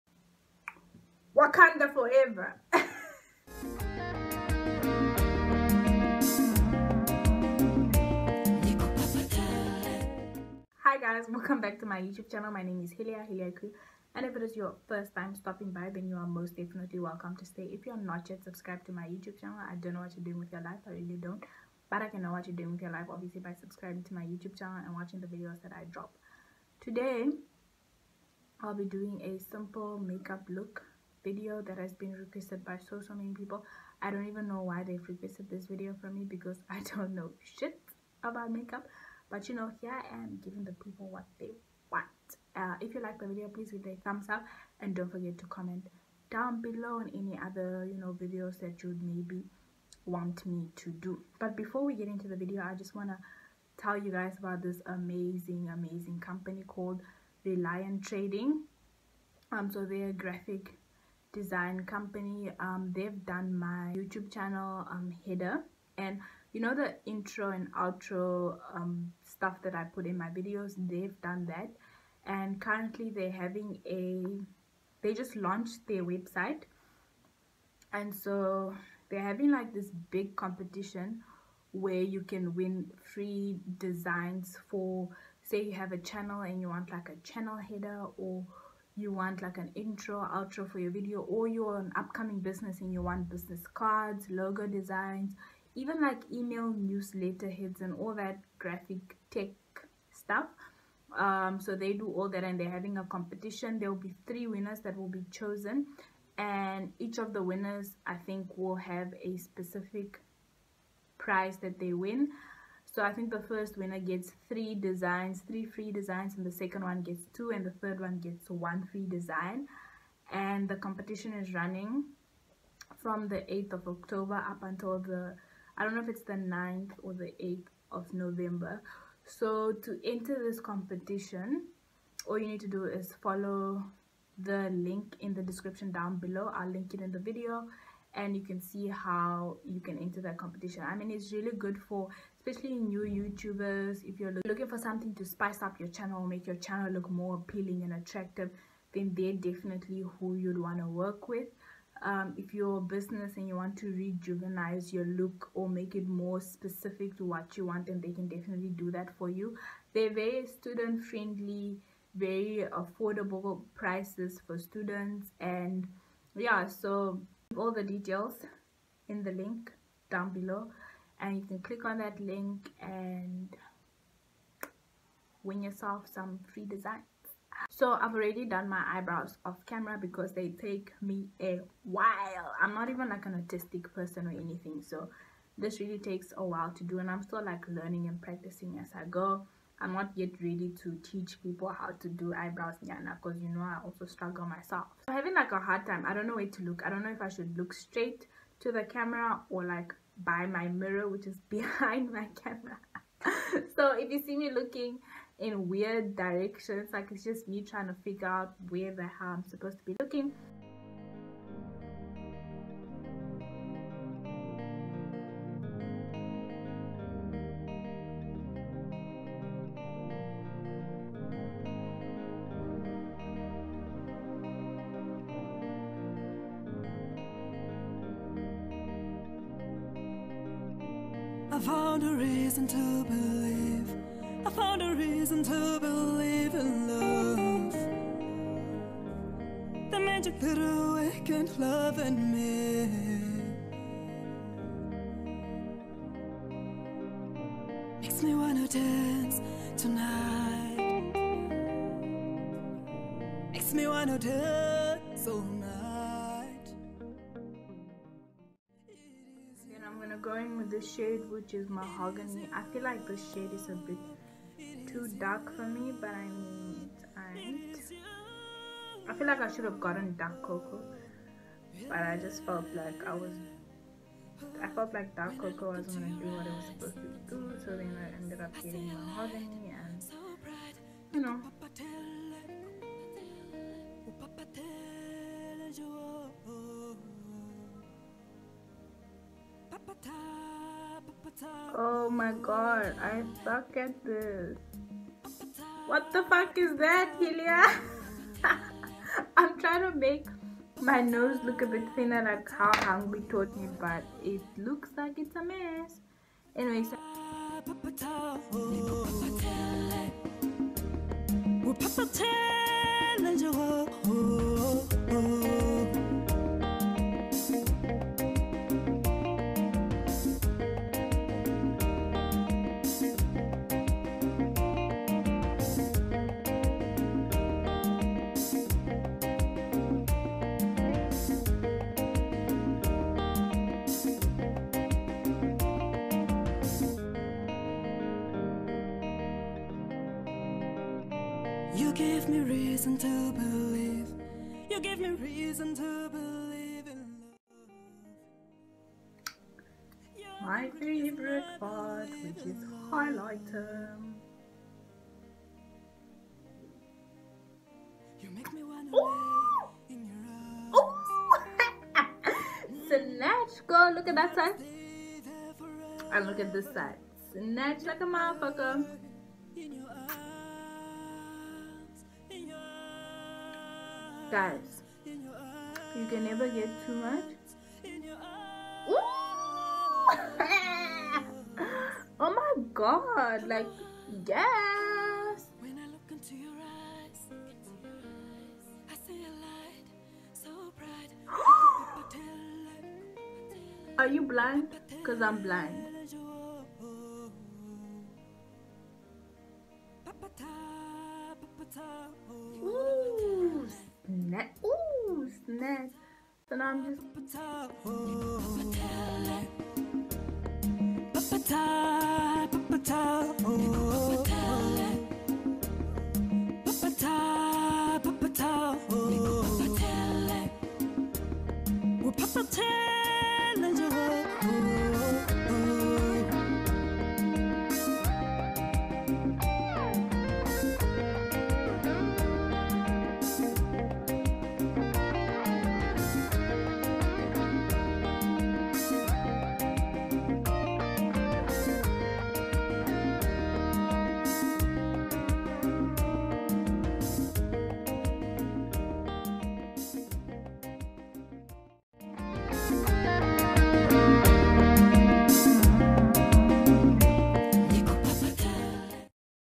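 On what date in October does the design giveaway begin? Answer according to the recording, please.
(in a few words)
8th of October.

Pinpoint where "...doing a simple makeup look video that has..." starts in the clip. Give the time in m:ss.
0:28.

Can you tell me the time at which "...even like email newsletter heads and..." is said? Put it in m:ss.
1:35.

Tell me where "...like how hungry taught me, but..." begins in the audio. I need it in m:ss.
5:02.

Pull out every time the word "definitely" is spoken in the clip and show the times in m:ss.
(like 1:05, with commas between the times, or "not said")
0:16, 2:29, 2:38.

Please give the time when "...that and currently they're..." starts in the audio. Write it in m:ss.
1:11.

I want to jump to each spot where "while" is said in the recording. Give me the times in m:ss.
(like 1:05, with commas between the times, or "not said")
3:01, 3:06.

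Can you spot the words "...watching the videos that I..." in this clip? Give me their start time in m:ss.
0:24.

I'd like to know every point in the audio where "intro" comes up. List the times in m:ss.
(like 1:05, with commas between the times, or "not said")
1:07, 1:29.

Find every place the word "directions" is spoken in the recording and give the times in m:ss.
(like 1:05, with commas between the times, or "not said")
3:26.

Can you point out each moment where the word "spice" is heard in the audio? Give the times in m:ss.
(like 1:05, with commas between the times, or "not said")
2:25.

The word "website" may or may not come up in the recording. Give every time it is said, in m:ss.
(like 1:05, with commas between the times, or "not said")
1:16.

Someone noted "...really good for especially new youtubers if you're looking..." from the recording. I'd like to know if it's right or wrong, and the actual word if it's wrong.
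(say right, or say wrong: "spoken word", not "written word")
right.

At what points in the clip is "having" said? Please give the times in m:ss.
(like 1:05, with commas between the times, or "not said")
1:13, 1:19, 1:42, 3:15.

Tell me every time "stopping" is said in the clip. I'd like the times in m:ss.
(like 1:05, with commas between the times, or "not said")
0:15.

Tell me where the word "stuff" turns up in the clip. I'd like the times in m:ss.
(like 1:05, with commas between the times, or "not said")
1:09, 1:40.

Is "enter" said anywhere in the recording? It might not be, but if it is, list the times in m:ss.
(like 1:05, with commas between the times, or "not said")
2:10, 2:19.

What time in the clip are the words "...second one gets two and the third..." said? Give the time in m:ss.
1:56.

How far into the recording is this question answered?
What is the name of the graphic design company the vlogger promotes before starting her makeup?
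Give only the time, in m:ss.
0:57.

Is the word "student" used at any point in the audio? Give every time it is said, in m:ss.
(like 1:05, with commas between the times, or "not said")
2:40, 2:44.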